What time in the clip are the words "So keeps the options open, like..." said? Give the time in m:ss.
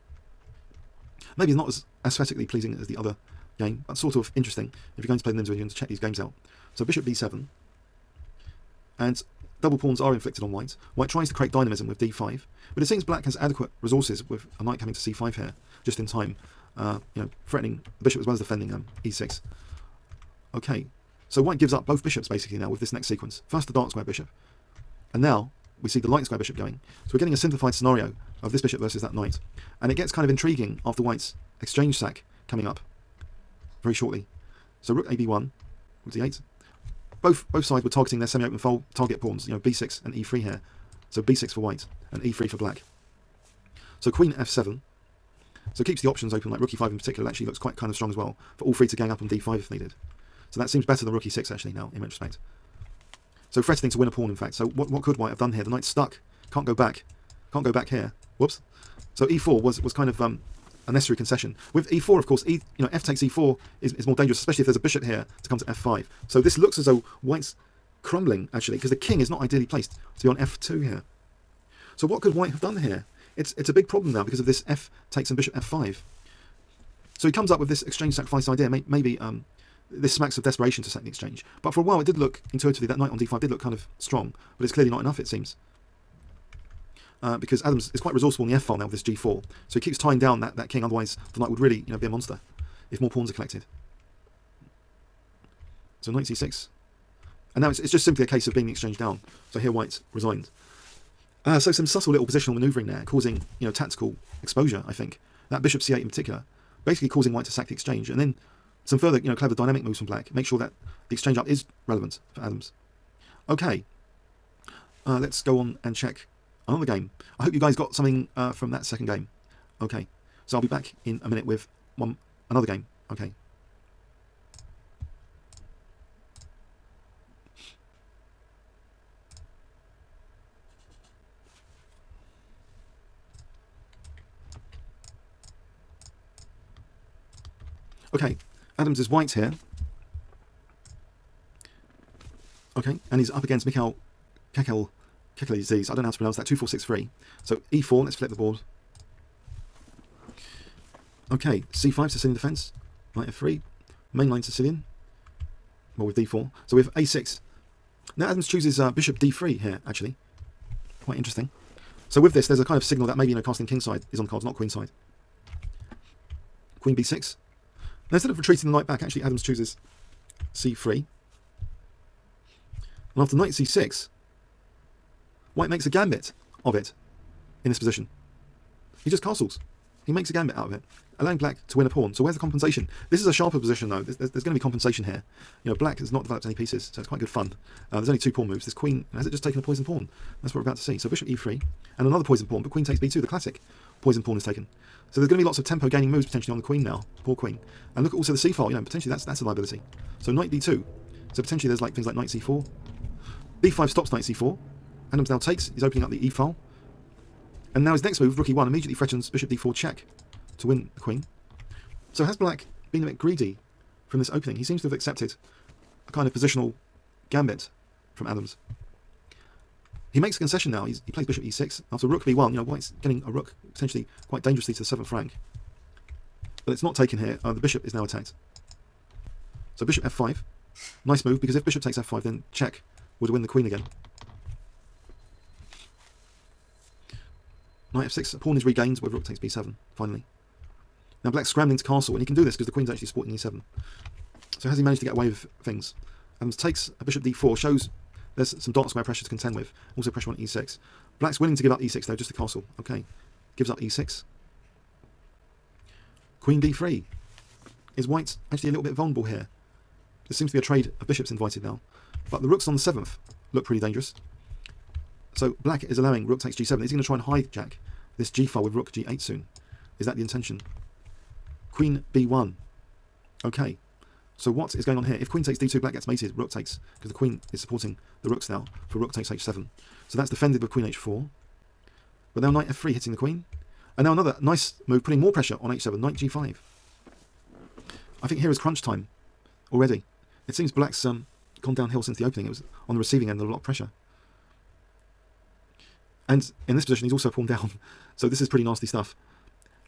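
0:45.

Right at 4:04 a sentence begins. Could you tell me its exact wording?
So has he managed to get away with things?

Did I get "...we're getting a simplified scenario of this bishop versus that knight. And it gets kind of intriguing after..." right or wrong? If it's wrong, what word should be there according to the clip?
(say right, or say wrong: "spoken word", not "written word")
right.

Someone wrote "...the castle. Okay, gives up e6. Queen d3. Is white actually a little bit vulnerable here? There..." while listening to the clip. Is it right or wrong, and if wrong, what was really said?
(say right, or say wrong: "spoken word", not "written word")
right.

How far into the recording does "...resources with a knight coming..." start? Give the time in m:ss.
0:13.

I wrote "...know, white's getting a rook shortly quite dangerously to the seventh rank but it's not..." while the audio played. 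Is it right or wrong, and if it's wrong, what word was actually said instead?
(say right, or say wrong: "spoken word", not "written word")
wrong: "potentially", not "shortly".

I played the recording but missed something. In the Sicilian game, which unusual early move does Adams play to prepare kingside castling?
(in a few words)
Bishop d3.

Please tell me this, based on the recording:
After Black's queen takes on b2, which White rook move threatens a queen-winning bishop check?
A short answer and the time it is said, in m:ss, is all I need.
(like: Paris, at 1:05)
Rook e1, at 3:28.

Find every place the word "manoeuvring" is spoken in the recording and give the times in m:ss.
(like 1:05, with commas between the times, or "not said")
1:42.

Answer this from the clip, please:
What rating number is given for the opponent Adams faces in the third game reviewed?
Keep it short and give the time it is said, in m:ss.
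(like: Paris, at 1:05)
2463, at 2:26.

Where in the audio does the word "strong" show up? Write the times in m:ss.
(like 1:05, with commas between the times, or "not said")
0:47, 1:23.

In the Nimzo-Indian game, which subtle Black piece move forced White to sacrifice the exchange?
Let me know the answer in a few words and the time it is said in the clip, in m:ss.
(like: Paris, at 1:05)
Bishop c8, at 1:45.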